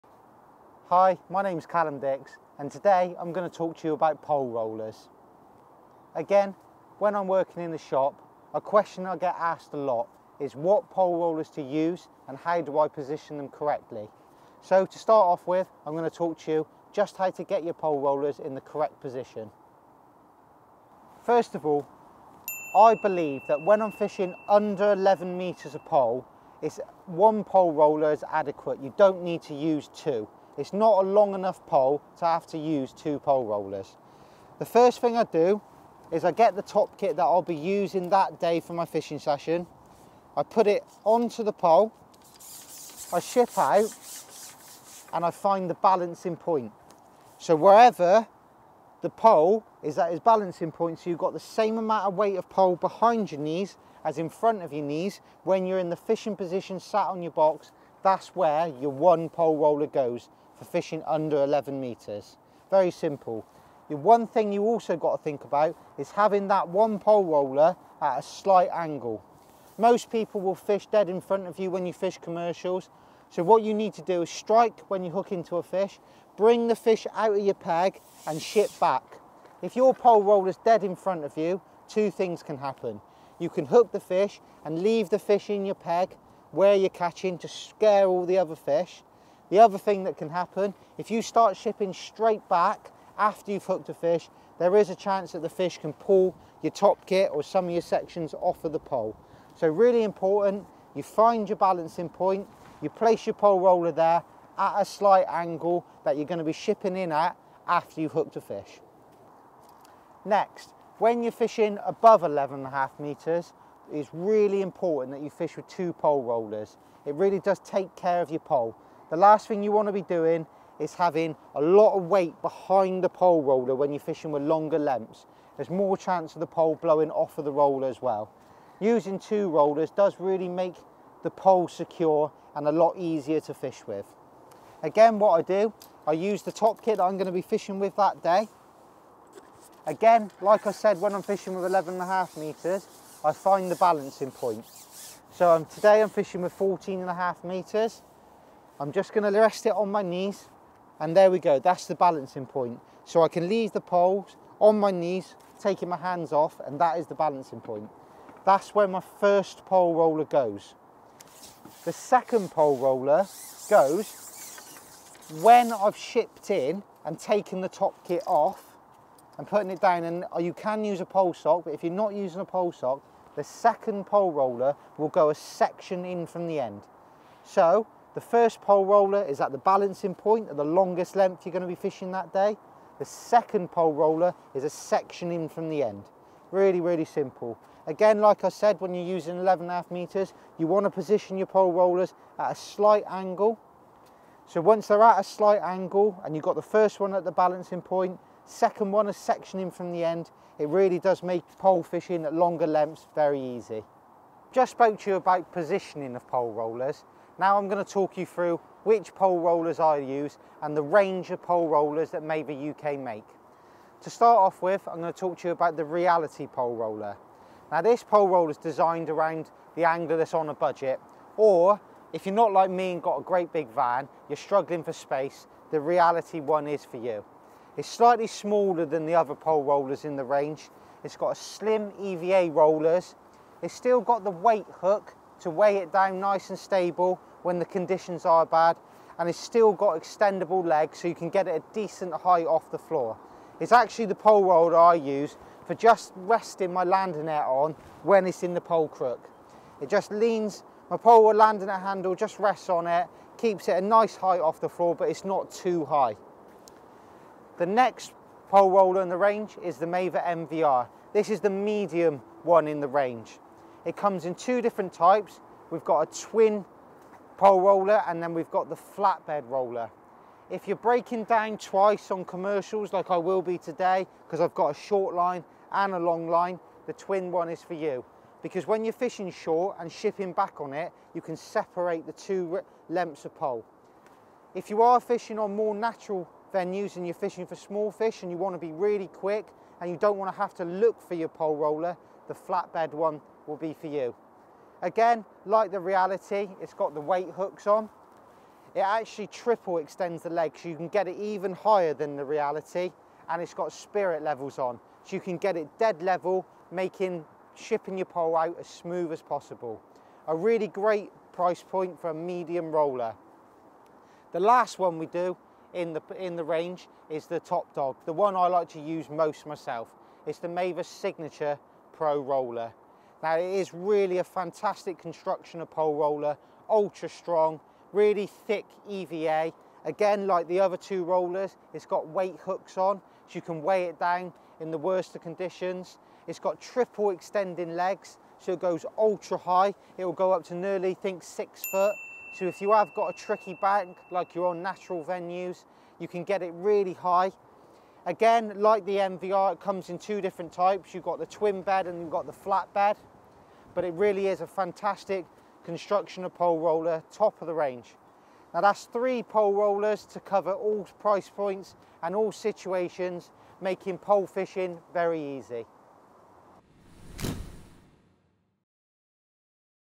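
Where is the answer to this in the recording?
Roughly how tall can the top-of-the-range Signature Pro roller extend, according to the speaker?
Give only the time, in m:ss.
5:40.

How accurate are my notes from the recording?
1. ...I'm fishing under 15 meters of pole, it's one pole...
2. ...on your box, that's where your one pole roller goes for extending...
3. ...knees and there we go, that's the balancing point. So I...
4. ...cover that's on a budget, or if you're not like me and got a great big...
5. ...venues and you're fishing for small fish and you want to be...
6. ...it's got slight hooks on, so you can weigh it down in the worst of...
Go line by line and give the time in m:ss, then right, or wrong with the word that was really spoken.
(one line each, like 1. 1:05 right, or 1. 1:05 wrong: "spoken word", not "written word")
1. 0:23 wrong: "11", not "15"
2. 0:57 wrong: "fishing", not "extending"
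3. 2:30 right
4. 3:39 wrong: "angler", not "cover"
5. 4:46 right
6. 5:31 wrong: "weight", not "slight".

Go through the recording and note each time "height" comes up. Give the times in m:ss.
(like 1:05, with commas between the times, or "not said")
4:02, 4:14.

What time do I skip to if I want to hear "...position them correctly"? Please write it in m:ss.
0:12.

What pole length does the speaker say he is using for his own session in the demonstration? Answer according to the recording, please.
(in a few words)
14 and a half meters.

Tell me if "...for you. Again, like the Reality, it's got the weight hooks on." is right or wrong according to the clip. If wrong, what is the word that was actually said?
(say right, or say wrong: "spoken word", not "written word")
right.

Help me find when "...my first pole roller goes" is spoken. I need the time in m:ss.
2:38.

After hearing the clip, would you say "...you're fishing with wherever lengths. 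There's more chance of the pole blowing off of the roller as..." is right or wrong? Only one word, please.
wrong.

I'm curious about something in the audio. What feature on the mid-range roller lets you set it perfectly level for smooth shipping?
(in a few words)
Spirit levels.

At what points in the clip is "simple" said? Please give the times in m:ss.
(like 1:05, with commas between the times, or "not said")
1:02, 3:07.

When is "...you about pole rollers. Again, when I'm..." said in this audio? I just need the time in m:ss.
0:03.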